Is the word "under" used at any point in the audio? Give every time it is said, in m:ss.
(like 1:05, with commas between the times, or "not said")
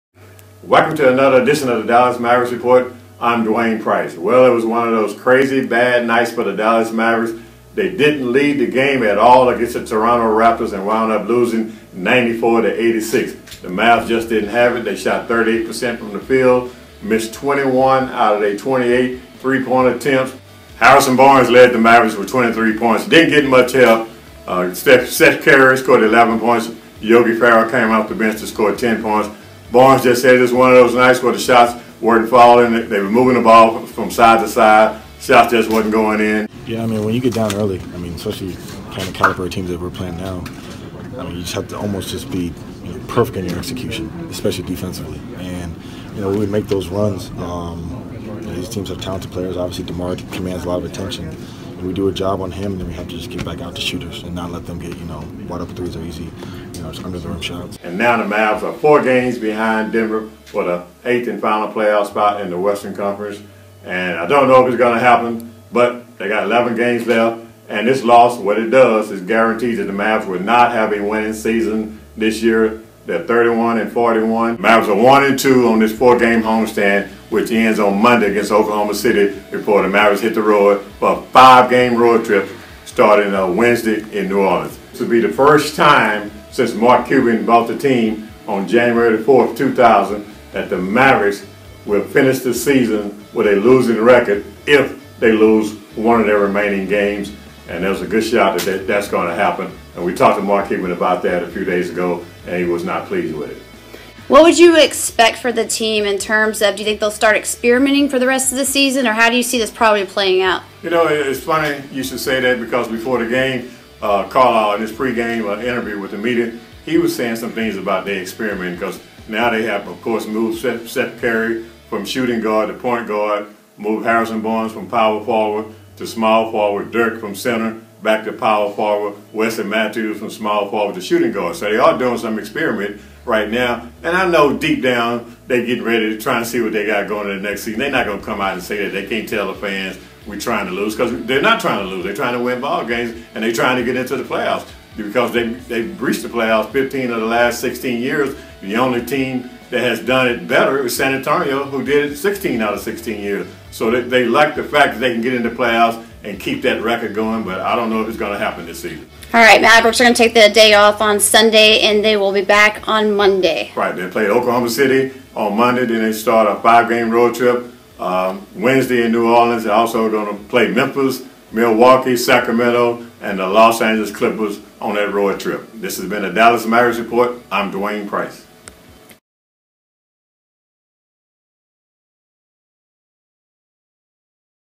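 0:57.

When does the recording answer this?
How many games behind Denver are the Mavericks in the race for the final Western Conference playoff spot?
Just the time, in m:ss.
0:58.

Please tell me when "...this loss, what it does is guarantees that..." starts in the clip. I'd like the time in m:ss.
1:07.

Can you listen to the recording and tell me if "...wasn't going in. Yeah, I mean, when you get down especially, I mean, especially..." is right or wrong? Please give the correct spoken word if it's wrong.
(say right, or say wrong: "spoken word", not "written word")
wrong: "early", not "especially".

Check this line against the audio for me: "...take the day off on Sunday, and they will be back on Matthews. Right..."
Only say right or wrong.
wrong.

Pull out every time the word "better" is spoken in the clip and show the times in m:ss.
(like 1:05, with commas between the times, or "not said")
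2:30.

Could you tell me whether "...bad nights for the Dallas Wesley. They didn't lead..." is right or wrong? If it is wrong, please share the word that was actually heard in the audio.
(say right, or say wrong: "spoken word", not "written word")
wrong: "Mavericks", not "Wesley".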